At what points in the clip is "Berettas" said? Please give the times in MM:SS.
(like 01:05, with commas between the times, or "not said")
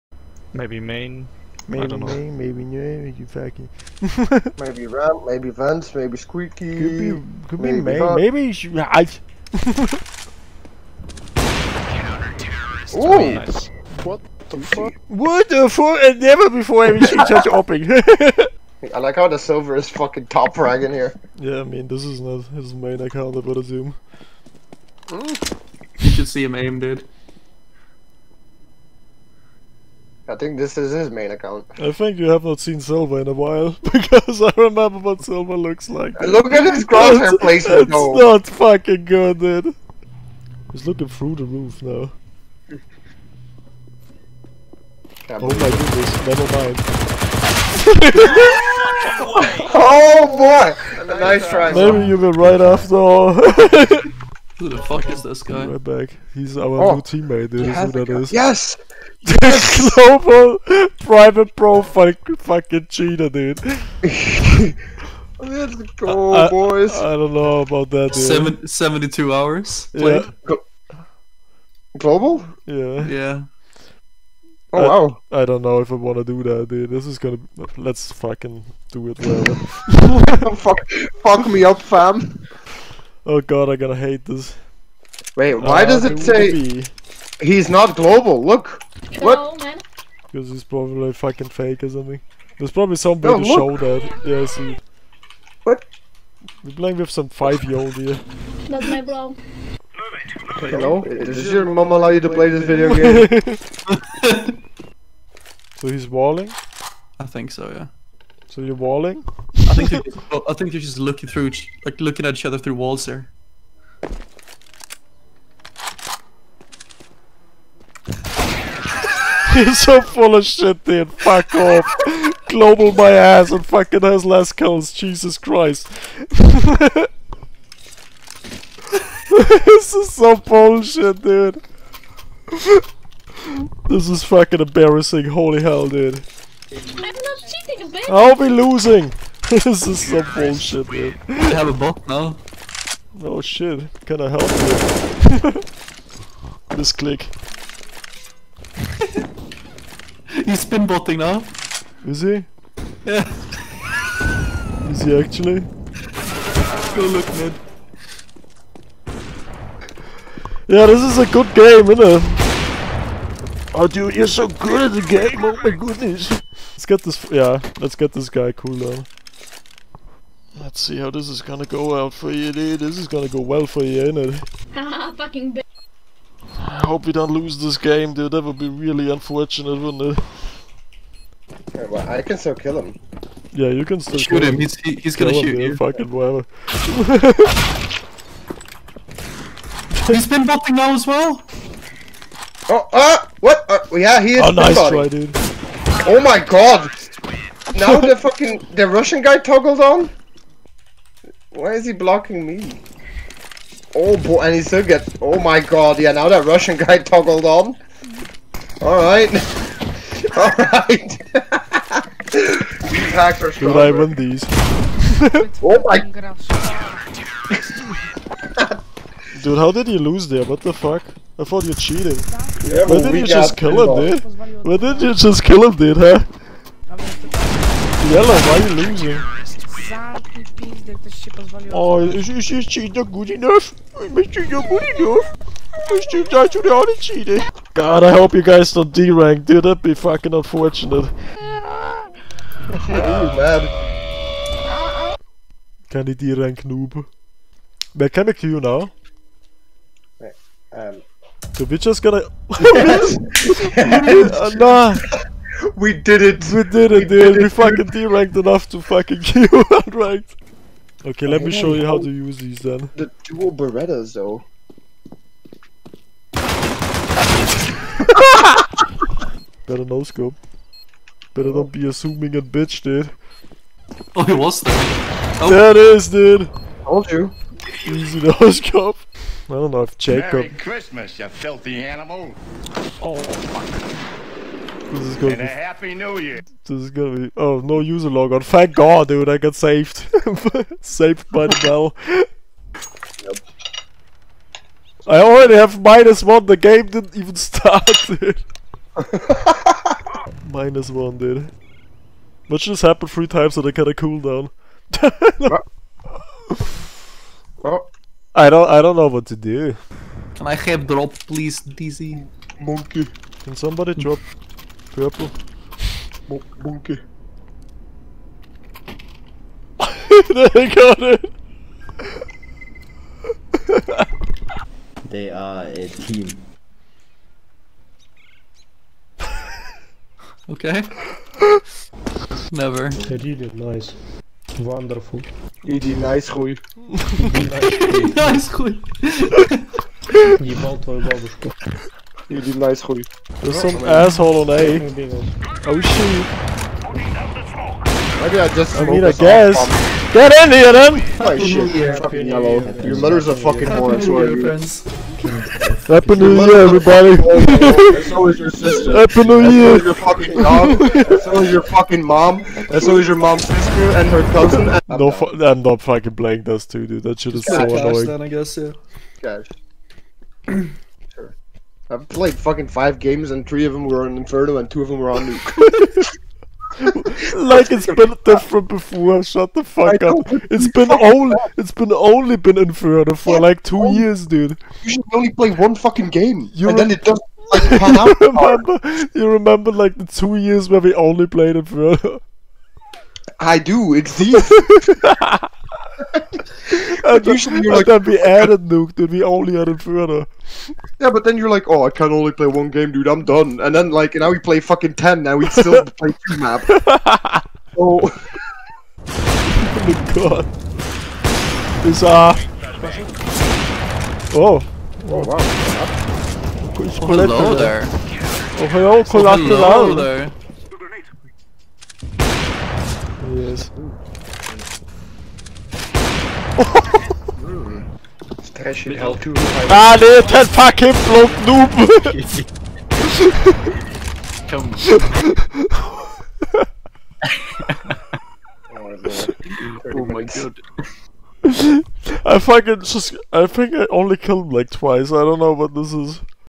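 04:23.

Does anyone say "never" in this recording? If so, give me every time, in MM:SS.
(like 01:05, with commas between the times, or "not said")
00:16, 00:46, 05:32.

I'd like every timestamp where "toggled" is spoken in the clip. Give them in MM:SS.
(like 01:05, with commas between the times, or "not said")
03:19, 03:26.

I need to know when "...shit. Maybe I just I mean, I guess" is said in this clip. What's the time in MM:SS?
05:45.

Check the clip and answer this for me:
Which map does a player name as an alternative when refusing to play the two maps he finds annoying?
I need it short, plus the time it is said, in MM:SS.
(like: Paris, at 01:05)
Cache, at 06:09.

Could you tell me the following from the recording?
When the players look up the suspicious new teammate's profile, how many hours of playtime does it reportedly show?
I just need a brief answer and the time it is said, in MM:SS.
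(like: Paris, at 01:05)
72, at 01:08.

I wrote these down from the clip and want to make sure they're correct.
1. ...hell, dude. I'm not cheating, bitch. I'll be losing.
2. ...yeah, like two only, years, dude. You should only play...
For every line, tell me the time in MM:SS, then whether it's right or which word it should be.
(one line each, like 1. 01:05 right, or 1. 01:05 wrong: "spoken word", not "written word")
1. 02:15 right
2. 06:23 right.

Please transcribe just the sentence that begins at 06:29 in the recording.
You remember like the two years where we only played Inferno.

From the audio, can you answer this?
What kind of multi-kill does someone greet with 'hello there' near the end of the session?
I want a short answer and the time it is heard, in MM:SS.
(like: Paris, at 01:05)
collateral, at 06:59.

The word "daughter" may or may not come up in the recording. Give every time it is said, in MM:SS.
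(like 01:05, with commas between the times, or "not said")
not said.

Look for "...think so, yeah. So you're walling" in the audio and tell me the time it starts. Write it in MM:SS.
01:47.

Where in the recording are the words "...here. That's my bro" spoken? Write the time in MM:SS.
01:37.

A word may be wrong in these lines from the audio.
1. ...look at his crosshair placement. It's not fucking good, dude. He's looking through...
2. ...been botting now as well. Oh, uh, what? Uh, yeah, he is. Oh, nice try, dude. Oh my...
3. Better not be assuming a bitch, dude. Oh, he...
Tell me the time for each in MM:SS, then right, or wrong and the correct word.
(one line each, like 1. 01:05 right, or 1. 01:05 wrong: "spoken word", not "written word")
1. 00:36 right
2. 03:10 right
3. 04:31 right.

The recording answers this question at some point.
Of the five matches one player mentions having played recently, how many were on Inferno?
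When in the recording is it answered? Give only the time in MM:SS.
06:13.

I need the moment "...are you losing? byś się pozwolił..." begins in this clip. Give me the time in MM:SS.
03:48.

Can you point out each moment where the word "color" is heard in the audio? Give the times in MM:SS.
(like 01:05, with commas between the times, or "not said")
not said.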